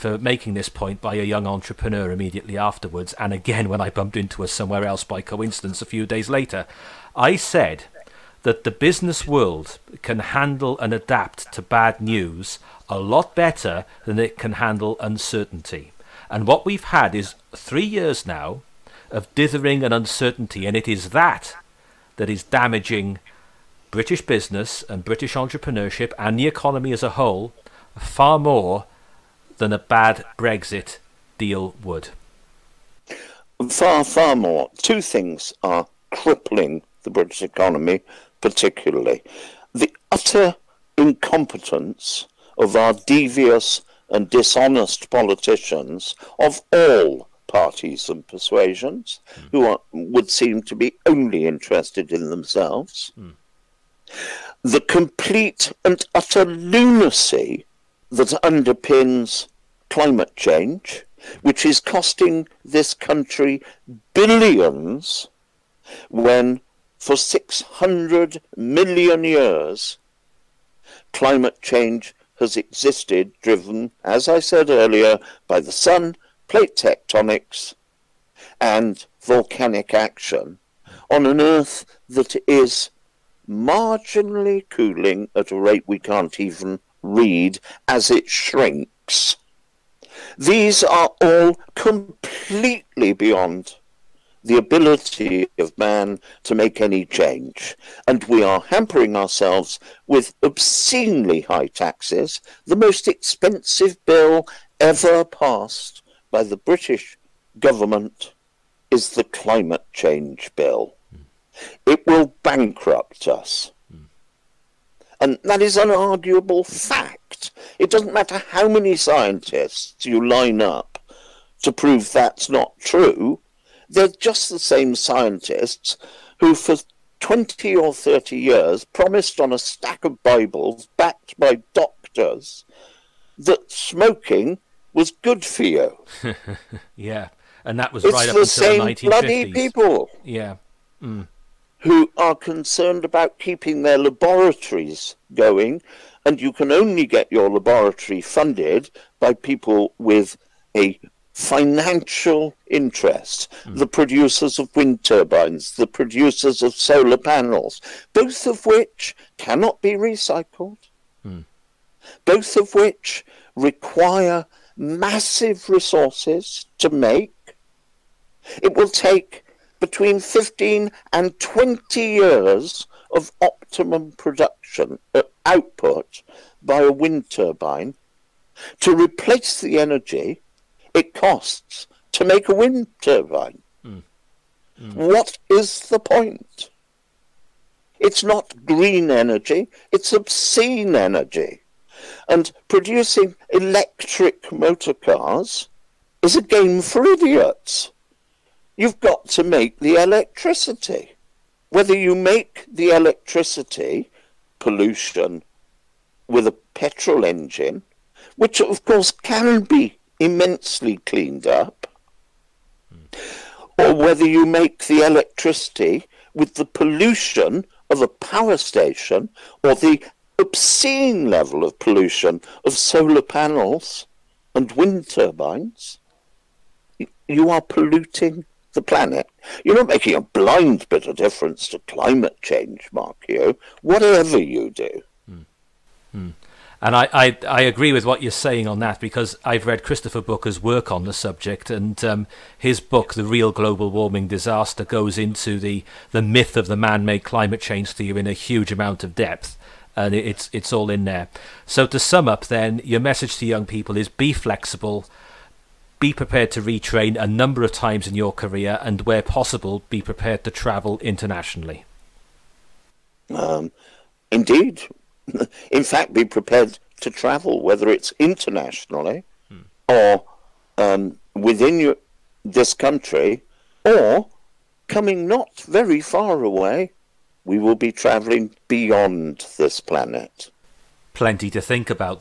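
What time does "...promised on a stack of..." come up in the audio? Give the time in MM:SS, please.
02:08.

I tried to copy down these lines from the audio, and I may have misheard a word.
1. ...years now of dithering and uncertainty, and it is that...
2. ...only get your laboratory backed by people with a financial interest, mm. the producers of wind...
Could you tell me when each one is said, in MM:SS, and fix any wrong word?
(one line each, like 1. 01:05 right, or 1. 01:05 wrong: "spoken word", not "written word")
1. 00:17 right
2. 02:26 wrong: "funded", not "backed".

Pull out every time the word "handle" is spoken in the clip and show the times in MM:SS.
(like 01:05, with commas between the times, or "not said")
00:10, 00:14.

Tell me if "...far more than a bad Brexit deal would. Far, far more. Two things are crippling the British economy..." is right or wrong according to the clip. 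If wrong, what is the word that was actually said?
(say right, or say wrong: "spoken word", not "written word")
right.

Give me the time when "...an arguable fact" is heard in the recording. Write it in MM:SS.
01:55.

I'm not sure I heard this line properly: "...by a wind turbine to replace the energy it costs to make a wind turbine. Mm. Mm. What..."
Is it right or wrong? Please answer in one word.
right.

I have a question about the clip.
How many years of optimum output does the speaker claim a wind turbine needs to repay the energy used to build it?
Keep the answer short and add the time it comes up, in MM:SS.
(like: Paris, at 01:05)
15 to 20 years, at 02:49.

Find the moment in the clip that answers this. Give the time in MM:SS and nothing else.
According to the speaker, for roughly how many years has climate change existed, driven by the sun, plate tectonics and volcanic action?
01:07.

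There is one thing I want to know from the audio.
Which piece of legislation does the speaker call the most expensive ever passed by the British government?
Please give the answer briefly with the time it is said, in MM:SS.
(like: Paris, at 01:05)
The climate change bill, at 01:49.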